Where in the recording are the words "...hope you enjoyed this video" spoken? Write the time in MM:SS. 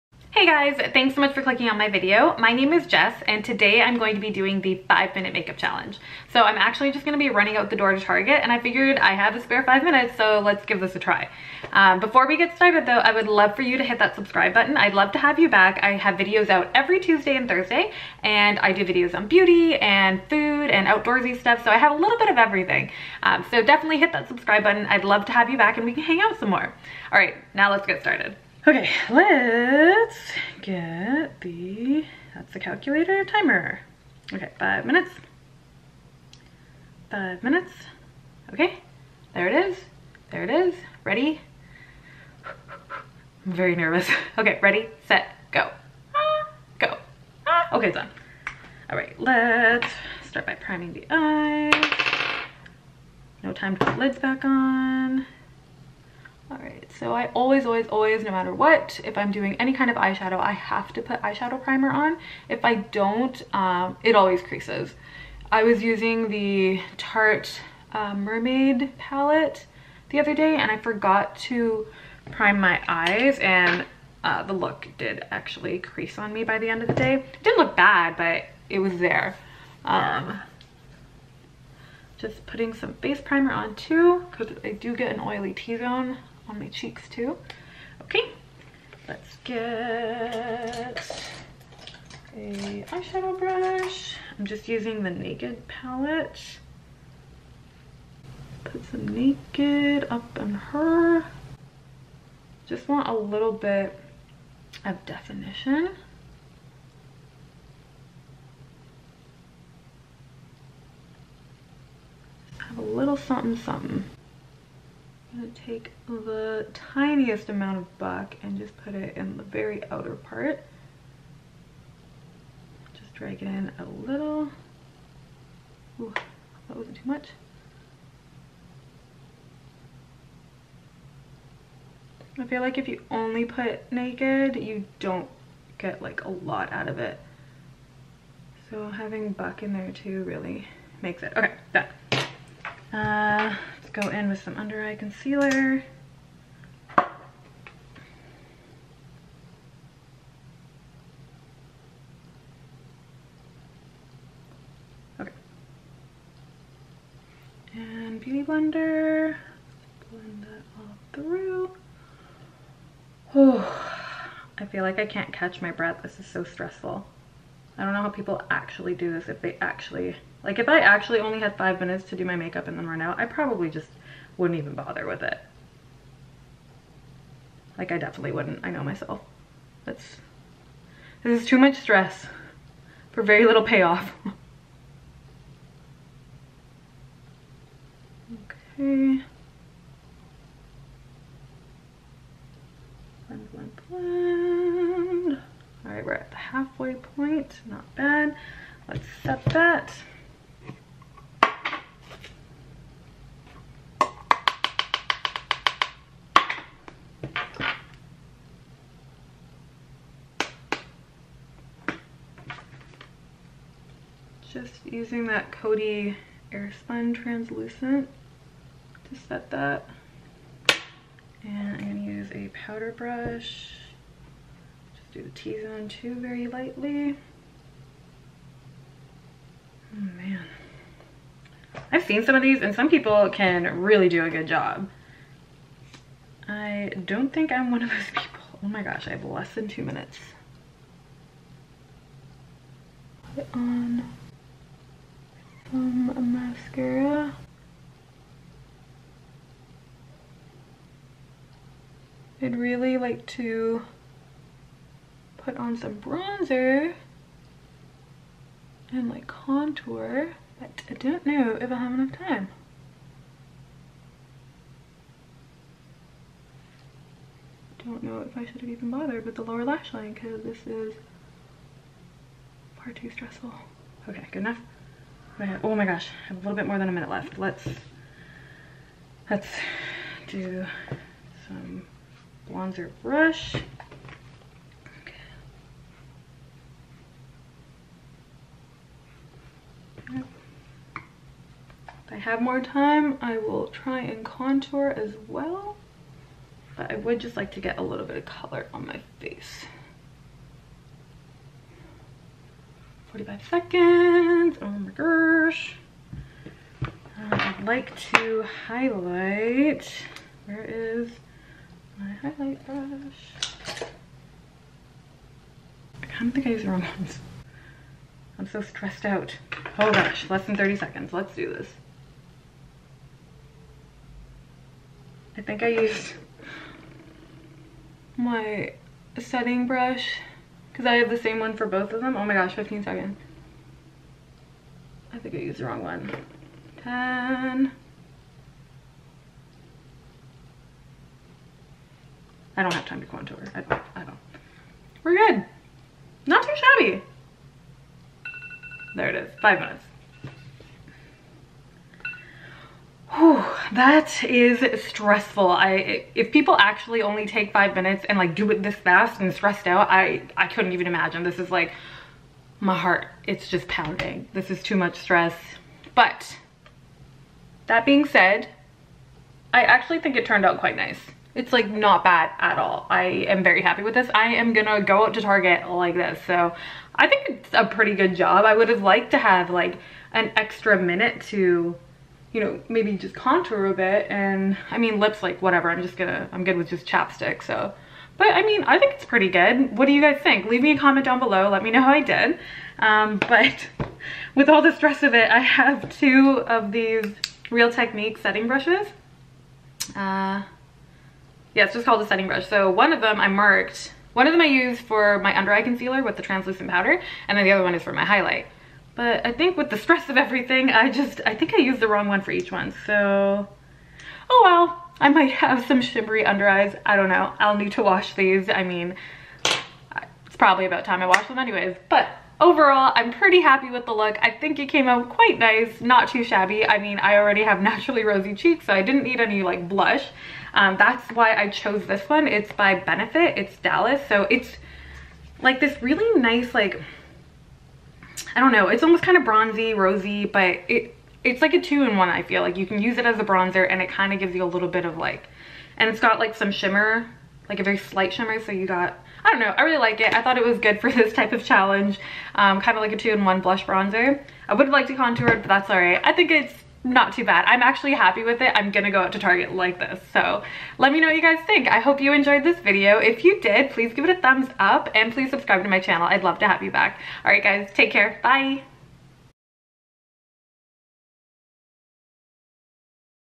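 07:41.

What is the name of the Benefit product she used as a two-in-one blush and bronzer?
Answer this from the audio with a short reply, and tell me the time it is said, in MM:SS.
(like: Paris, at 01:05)
Dallas, at 07:13.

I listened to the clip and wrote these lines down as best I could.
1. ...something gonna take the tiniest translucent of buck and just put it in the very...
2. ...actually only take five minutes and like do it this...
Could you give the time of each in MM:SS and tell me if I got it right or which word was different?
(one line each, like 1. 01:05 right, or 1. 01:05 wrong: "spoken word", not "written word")
1. 01:53 wrong: "amount", not "translucent"
2. 05:56 right.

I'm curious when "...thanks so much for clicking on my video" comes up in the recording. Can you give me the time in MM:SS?
00:00.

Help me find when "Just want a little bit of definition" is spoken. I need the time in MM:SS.
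01:42.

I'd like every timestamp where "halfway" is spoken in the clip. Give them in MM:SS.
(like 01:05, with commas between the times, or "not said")
03:16.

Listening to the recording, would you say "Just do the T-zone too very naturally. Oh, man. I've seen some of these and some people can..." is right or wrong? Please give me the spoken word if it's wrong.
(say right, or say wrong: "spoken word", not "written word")
wrong: "lightly", not "naturally".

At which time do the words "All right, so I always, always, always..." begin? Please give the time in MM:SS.
00:56.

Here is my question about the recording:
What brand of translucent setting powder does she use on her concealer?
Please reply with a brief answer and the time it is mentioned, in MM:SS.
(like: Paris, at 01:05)
Coty Airspun, at 03:35.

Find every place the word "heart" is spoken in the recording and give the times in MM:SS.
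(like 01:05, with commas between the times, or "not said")
06:02.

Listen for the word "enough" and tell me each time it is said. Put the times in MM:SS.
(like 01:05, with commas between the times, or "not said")
04:21, 04:34.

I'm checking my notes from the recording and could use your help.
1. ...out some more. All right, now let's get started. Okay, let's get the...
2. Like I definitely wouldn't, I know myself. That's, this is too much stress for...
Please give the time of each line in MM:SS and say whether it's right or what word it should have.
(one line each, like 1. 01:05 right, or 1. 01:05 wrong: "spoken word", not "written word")
1. 00:26 right
2. 02:57 right.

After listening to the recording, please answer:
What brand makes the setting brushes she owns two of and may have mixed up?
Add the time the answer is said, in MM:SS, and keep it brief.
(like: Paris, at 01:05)
Real Technique, at 06:37.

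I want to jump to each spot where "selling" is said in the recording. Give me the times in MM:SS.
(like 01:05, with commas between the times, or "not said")
not said.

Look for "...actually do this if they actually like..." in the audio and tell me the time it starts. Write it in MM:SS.
02:48.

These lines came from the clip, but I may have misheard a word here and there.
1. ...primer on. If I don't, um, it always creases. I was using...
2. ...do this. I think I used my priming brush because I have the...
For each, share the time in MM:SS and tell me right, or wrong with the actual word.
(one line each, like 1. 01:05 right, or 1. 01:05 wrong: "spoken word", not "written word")
1. 01:01 right
2. 05:21 wrong: "setting", not "priming".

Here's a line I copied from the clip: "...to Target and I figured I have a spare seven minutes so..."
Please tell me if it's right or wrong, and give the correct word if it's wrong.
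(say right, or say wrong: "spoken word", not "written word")
wrong: "five", not "seven".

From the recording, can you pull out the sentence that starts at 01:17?
It didn't look bad, but it was there.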